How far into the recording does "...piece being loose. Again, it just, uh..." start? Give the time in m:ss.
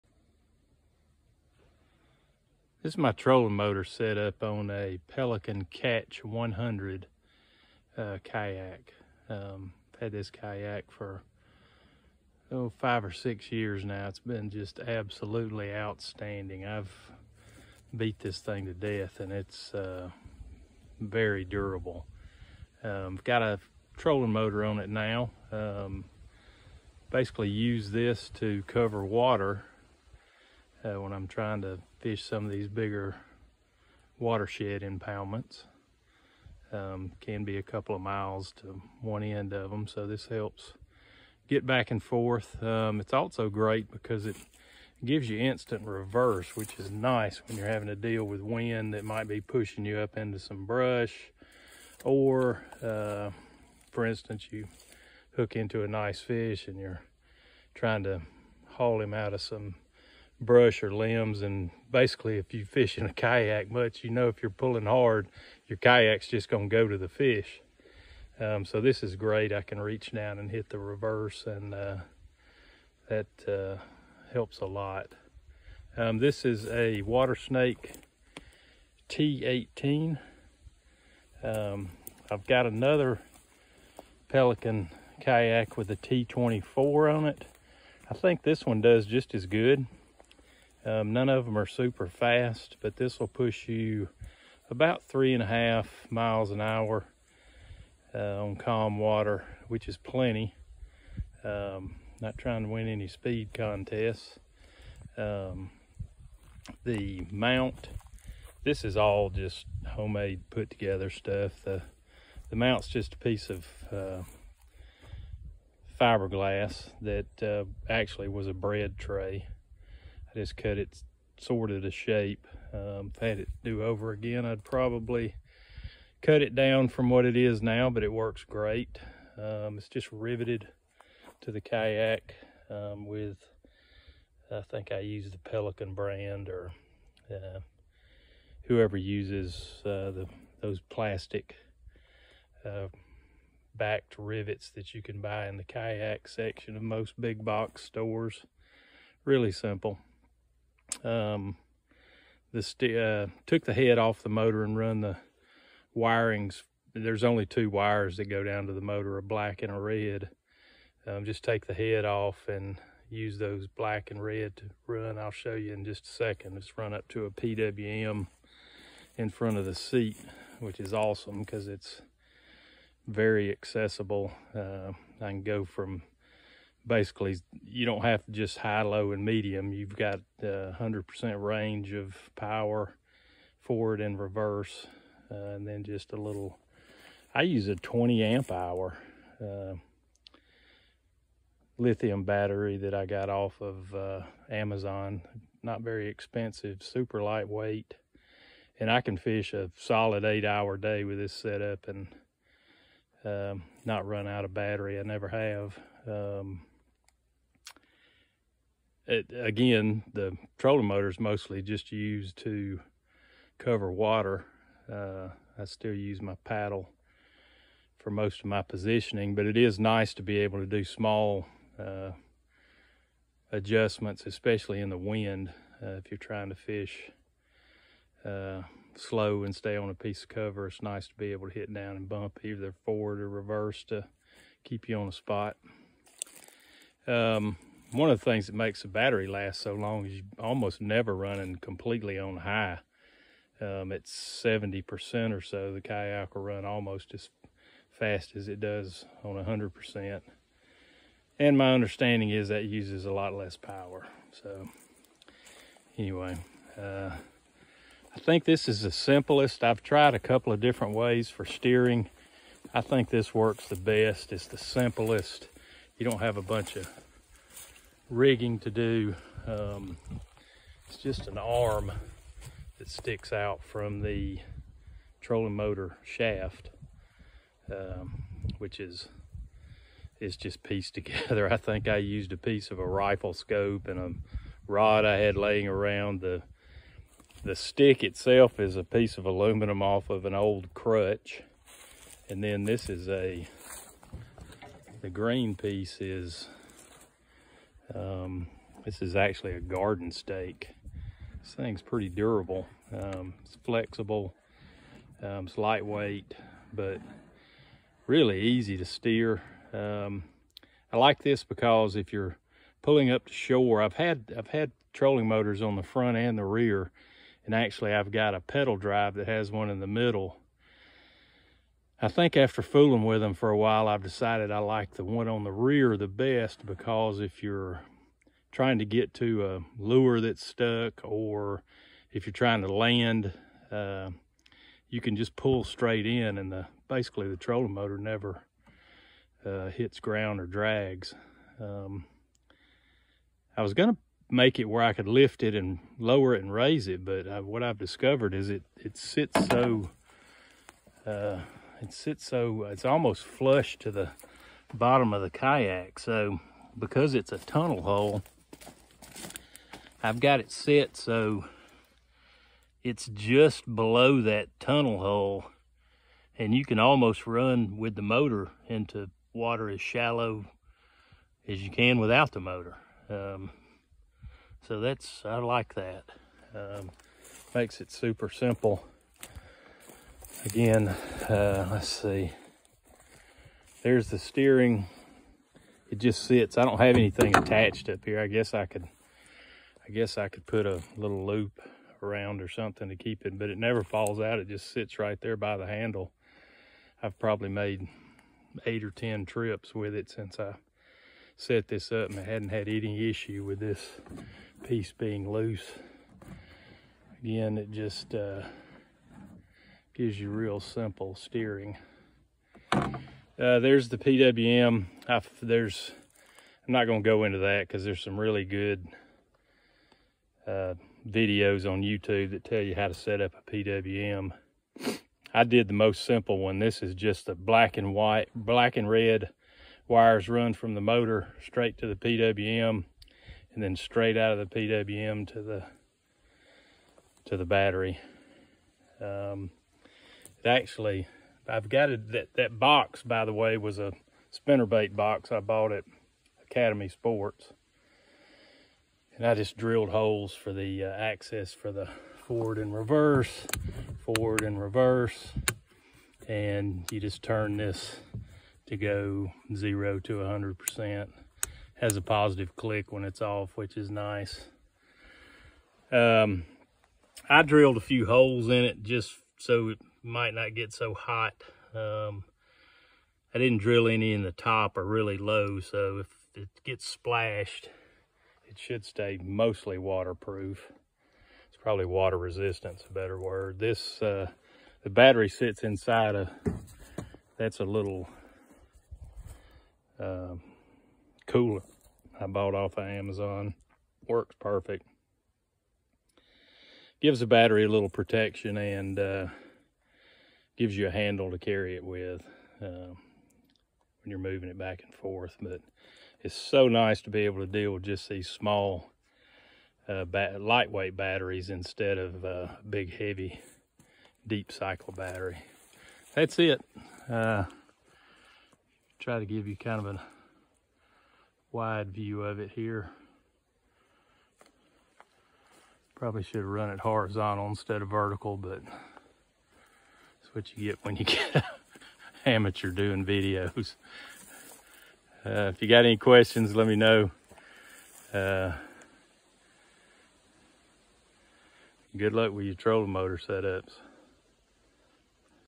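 6:44.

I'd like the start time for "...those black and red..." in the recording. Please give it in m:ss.
2:43.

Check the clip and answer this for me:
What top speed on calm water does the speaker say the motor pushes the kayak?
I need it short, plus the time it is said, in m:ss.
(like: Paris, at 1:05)
3.5 miles an hour, at 1:35.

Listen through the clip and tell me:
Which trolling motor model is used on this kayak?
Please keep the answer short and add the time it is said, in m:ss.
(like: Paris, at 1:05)
Watersnake T18, at 1:17.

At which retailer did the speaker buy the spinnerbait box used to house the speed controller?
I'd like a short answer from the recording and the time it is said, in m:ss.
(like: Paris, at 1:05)
Academy Sports, at 7:26.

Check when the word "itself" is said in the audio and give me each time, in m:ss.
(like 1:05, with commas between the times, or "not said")
4:48.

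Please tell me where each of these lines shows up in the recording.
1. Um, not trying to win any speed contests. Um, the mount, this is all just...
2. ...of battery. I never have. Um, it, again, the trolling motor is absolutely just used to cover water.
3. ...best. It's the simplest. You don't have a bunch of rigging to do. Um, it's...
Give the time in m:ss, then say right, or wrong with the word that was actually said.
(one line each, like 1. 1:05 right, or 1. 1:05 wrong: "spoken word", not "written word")
1. 1:41 right
2. 3:24 wrong: "mostly", not "absolutely"
3. 4:23 right.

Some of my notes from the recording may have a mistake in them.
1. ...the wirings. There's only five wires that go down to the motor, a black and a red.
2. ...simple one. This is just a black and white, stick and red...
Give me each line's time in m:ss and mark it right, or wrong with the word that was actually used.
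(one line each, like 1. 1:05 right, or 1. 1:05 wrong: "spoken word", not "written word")
1. 2:35 wrong: "two", not "five"
2. 7:06 wrong: "black", not "stick".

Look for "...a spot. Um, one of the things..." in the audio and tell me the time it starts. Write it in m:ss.
3:55.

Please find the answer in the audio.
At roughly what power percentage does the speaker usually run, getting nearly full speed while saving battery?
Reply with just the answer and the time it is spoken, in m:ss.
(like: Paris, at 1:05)
70%, at 4:04.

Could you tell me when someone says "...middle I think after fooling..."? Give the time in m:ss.
5:19.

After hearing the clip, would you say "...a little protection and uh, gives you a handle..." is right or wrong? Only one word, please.
right.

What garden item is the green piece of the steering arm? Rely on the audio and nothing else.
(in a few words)
garden stake.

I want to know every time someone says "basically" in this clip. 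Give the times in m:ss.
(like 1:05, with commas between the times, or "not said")
0:27, 1:01, 2:56, 5:36.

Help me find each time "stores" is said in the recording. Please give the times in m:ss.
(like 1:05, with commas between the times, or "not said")
2:27.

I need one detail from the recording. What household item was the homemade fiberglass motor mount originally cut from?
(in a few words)
bread tray.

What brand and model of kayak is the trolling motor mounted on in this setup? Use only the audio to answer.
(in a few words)
Pelican Catch 100.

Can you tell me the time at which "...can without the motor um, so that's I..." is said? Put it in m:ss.
6:11.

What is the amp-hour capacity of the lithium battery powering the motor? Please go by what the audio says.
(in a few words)
20 amp hour.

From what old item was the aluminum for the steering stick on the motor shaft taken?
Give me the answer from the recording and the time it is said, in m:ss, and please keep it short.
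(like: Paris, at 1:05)
crutch, at 4:50.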